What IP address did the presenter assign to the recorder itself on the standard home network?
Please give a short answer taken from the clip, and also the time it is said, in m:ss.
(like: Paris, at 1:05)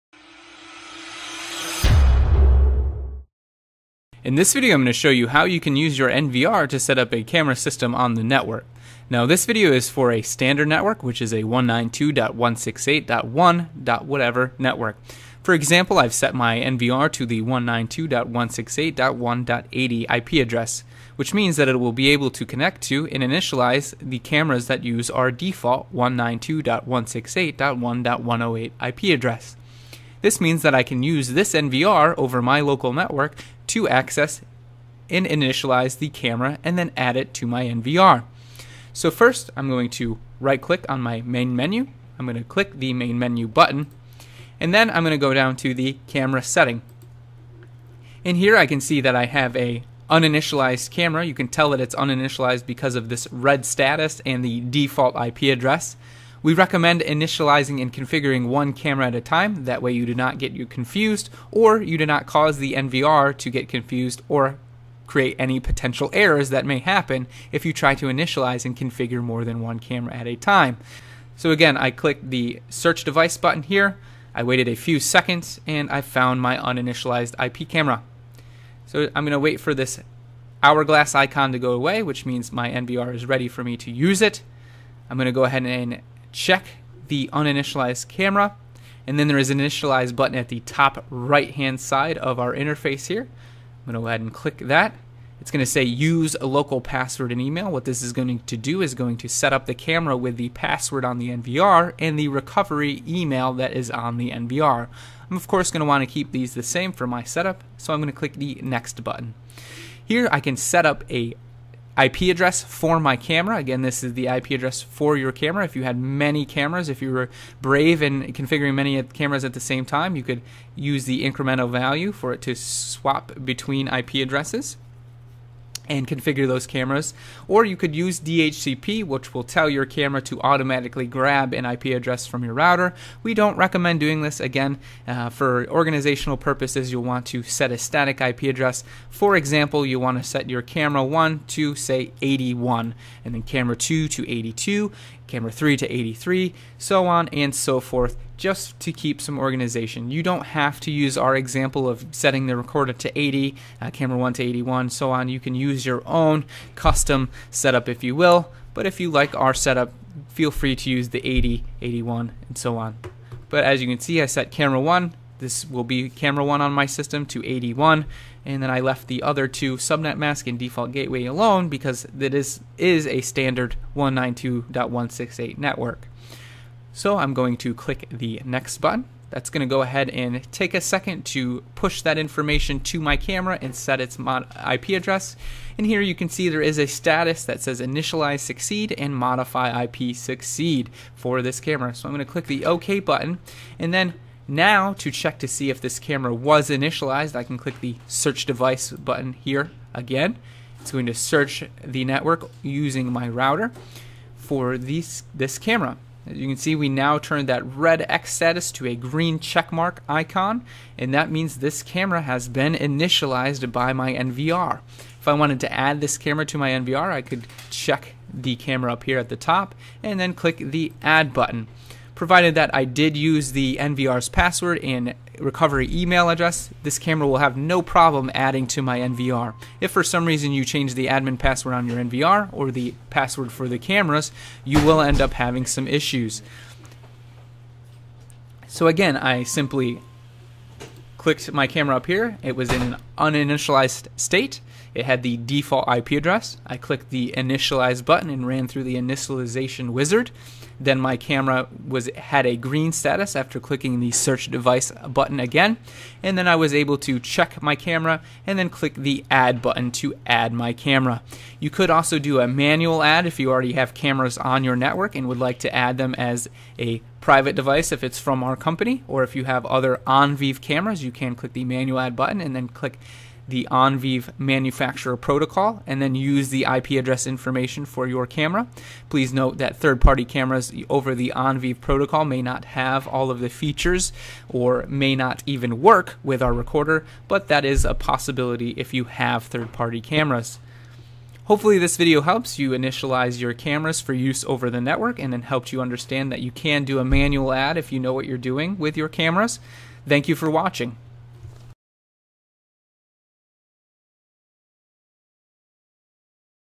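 192.168.1.80, at 0:17.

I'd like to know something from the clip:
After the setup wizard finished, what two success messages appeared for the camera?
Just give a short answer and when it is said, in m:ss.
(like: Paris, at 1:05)
initialize succeed and modify IP succeed, at 3:07.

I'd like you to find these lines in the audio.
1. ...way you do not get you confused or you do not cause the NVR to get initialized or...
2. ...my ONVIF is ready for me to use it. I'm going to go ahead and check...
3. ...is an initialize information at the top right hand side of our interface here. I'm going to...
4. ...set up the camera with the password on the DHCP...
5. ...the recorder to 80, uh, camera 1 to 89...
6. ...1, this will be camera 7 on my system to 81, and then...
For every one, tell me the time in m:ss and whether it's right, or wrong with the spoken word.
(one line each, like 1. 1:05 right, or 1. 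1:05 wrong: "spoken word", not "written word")
1. 0:59 wrong: "confused", not "initialized"
2. 1:22 wrong: "NVR", not "ONVIF"
3. 1:29 wrong: "button", not "information"
4. 1:39 wrong: "NVR", not "DHCP"
5. 2:32 wrong: "81", not "89"
6. 2:44 wrong: "1", not "7".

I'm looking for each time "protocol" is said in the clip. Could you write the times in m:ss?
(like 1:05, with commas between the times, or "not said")
4:35, 4:41.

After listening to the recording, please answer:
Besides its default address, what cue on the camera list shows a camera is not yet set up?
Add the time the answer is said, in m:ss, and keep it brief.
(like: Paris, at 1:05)
red status, at 0:53.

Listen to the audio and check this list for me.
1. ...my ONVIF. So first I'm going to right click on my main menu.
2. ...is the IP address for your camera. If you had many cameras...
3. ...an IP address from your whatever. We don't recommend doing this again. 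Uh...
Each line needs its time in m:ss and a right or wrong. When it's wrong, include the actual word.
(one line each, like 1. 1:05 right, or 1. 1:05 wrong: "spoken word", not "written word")
1. 0:37 wrong: "NVR", not "ONVIF"
2. 1:54 right
3. 2:11 wrong: "router", not "whatever".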